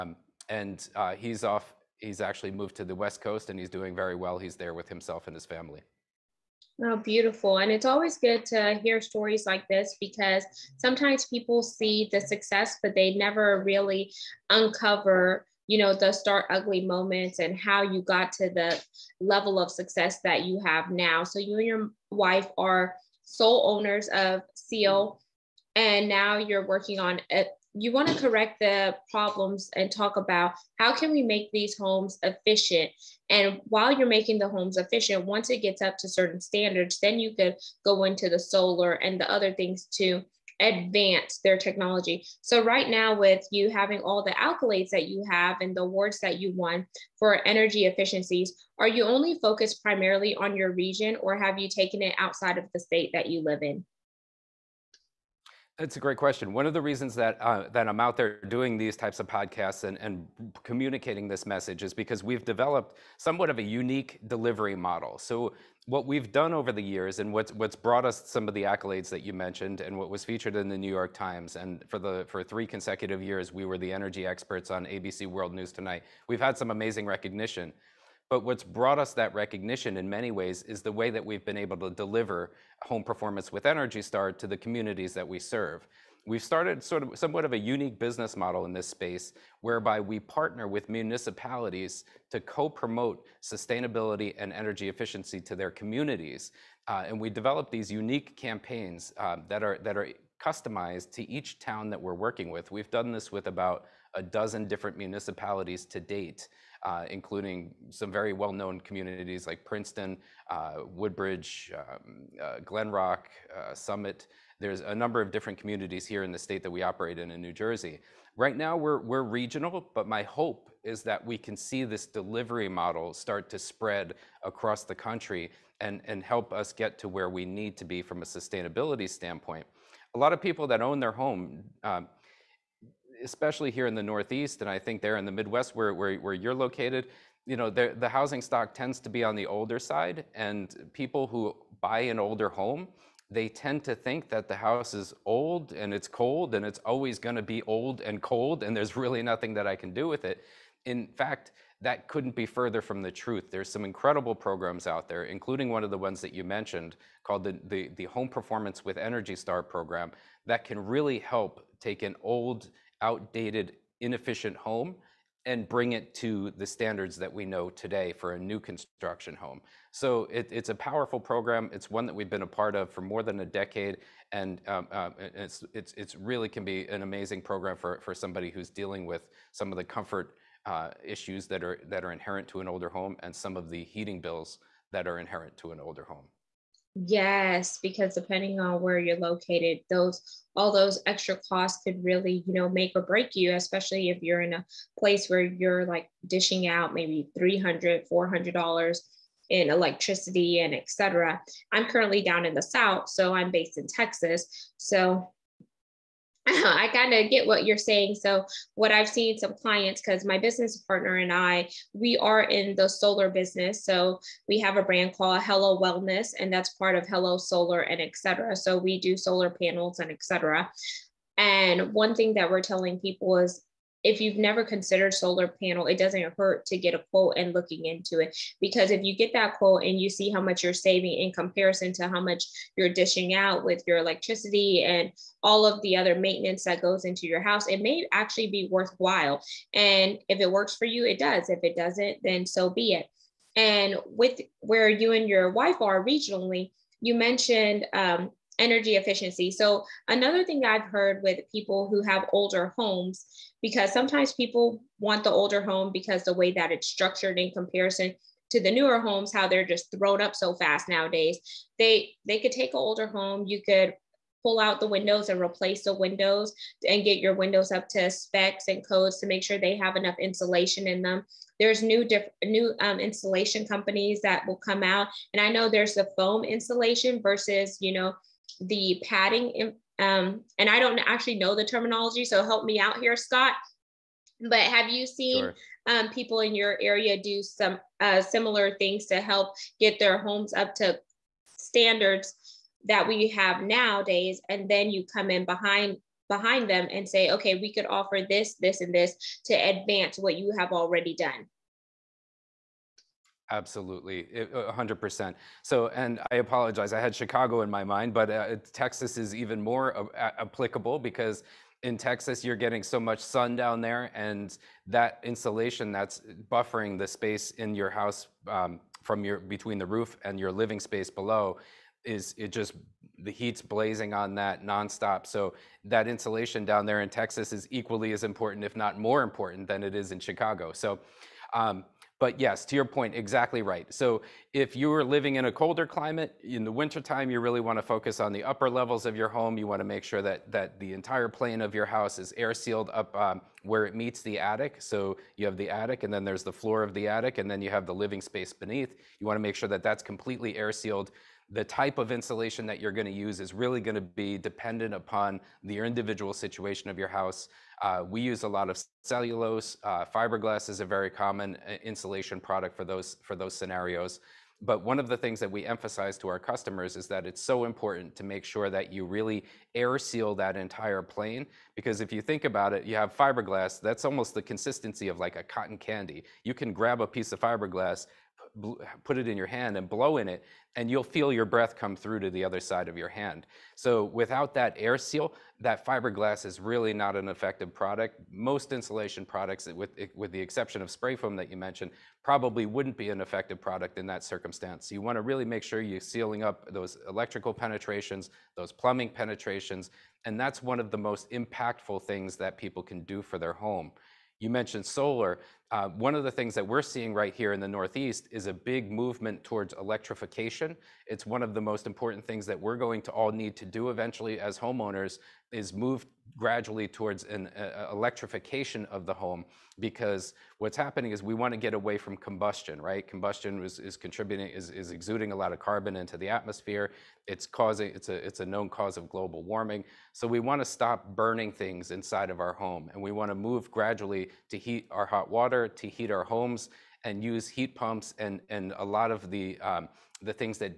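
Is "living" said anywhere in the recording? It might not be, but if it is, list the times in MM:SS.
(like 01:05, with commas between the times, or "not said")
05:20, 05:35, 05:47.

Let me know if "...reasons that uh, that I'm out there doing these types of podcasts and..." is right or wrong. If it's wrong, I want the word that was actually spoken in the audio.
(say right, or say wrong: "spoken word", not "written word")
right.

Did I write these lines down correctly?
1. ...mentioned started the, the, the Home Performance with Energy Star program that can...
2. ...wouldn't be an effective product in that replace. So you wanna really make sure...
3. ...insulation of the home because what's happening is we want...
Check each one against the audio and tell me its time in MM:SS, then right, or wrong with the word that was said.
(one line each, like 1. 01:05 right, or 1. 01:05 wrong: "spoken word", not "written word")
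1. 02:36 wrong: "called", not "started"
2. 06:32 wrong: "circumstance", not "replace"
3. 06:57 wrong: "electrification", not "insulation".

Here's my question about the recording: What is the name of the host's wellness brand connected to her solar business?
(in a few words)
Hello Wellness.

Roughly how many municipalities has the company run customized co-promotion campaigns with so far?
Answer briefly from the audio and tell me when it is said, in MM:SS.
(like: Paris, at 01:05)
About a dozen, at 01:43.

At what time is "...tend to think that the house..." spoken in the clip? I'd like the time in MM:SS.
02:23.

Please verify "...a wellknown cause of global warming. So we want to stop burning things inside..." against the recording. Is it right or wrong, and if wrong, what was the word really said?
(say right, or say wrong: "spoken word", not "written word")
wrong: "known", not "wellknown".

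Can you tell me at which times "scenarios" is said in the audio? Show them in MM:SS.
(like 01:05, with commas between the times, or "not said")
06:03.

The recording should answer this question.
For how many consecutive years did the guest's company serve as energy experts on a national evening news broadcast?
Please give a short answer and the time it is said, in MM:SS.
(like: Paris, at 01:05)
3, at 01:12.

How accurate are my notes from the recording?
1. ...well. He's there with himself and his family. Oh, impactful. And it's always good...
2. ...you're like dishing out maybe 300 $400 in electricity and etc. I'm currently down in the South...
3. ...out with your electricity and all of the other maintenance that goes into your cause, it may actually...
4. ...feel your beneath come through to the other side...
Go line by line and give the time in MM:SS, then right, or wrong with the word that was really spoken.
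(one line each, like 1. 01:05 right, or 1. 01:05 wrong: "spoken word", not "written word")
1. 00:04 wrong: "beautiful", not "impactful"
2. 03:15 right
3. 03:53 wrong: "house", not "cause"
4. 06:21 wrong: "breath", not "beneath".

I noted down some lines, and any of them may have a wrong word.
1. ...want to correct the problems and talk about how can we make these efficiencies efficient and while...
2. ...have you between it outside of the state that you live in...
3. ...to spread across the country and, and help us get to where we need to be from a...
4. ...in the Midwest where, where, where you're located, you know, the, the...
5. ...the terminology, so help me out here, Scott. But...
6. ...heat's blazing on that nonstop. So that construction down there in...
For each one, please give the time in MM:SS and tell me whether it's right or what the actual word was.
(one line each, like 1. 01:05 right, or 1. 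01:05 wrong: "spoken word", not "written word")
1. 00:27 wrong: "homes", not "efficiencies"
2. 00:51 wrong: "taken", not "between"
3. 02:03 right
4. 02:15 right
5. 04:41 right
6. 05:23 wrong: "insulation", not "construction".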